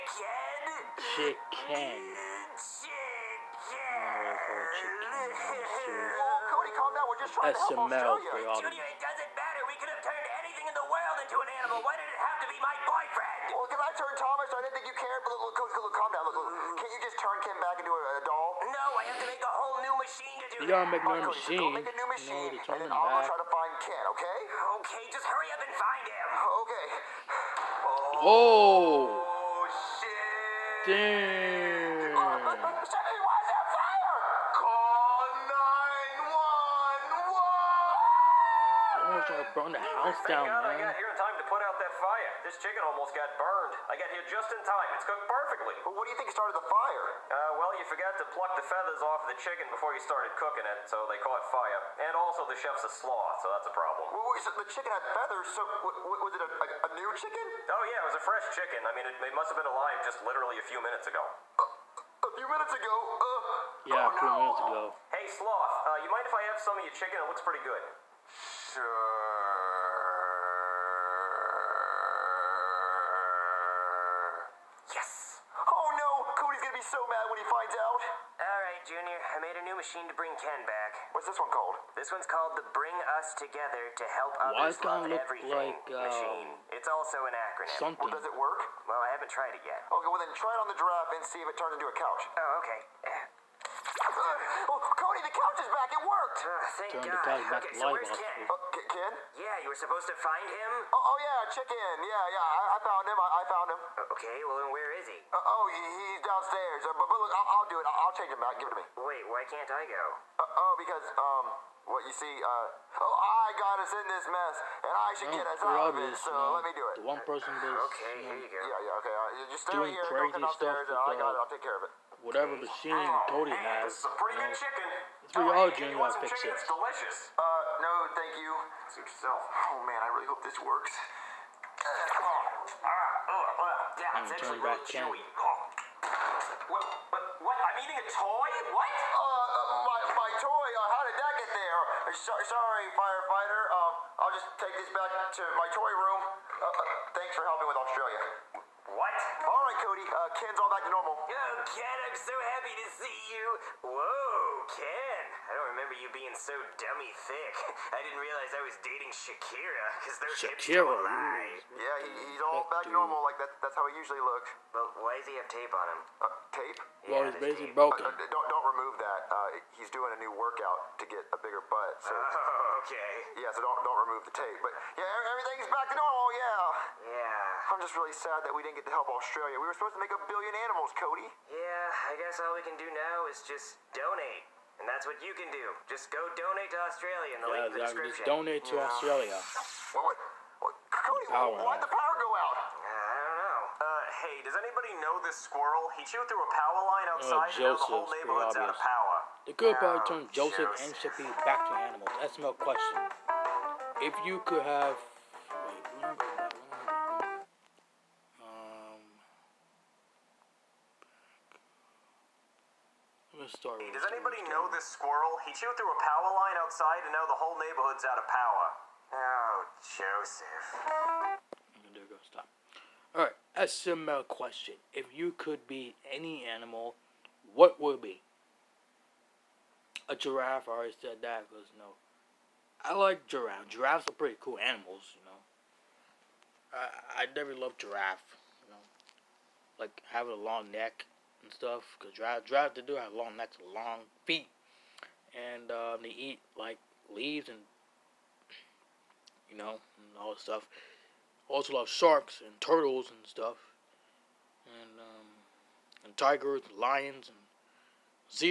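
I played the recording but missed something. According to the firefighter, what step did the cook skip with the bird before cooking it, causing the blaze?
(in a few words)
Pluck the feathers.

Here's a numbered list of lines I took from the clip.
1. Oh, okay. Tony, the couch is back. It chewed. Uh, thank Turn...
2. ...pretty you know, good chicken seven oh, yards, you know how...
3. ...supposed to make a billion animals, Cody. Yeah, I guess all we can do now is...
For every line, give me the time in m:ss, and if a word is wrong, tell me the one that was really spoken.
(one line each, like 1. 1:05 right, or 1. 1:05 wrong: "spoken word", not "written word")
1. 1:32 wrong: "worked", not "chewed"
2. 2:04 wrong: "three", not "seven"
3. 2:59 right.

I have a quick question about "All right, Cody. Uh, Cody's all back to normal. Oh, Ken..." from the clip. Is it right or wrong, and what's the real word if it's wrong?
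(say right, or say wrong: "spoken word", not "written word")
wrong: "Ken", not "Cody".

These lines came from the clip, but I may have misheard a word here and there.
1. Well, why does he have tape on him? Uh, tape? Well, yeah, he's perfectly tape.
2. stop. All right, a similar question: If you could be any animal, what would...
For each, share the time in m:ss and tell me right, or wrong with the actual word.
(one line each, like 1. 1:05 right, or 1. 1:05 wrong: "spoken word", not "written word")
1. 2:44 wrong: "basically", not "perfectly"
2. 3:42 right.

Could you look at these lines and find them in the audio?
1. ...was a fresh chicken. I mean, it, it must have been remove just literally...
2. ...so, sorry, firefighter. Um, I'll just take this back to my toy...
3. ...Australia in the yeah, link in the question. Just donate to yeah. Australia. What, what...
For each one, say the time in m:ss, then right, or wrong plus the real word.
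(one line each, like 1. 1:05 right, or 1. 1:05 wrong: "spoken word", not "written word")
1. 0:58 wrong: "alive", not "remove"
2. 2:22 right
3. 3:06 wrong: "description", not "question".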